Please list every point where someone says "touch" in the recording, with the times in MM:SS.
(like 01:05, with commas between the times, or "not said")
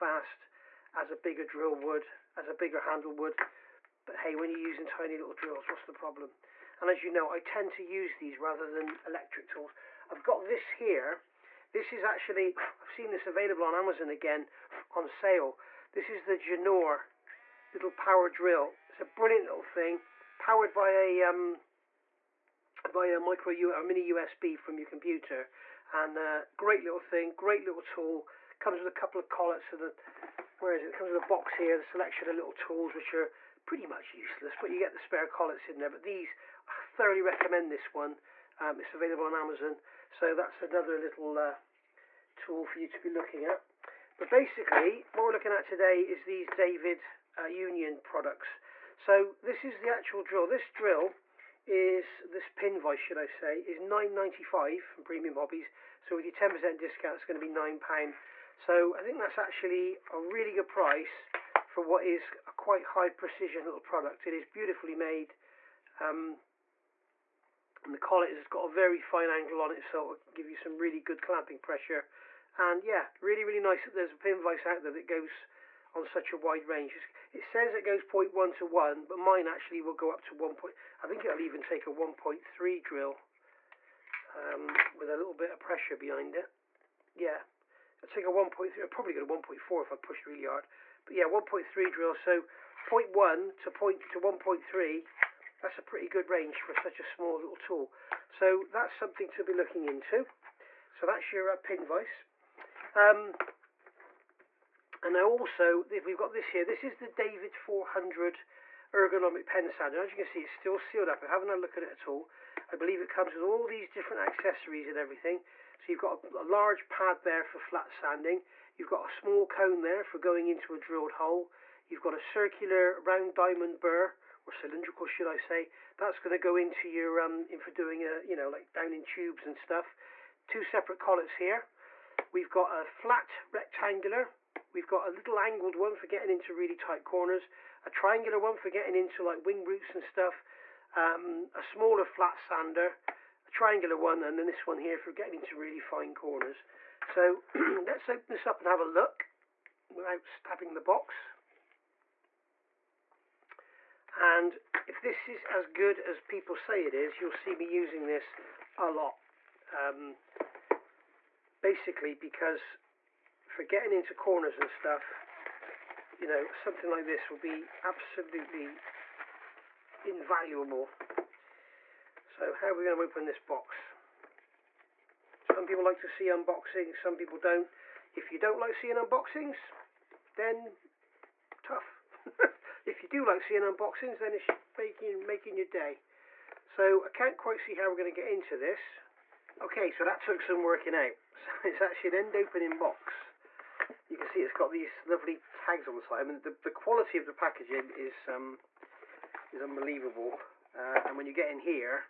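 not said.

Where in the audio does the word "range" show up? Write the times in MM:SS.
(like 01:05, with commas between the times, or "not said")
01:16, 01:36.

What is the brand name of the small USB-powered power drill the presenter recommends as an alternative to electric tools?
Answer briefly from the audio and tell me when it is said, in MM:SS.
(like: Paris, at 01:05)
Janor, at 00:16.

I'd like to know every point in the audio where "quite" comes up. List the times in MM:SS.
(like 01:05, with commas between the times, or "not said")
01:02, 03:07.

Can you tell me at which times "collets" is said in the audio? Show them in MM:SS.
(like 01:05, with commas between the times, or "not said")
00:29, 00:35, 01:07, 02:10.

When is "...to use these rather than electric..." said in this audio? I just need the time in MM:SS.
00:07.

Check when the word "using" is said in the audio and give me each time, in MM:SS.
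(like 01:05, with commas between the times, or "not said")
00:04, 02:37.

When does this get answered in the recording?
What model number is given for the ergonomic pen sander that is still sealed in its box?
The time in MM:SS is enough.
01:47.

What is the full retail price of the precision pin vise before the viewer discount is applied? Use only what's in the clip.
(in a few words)
£9.95.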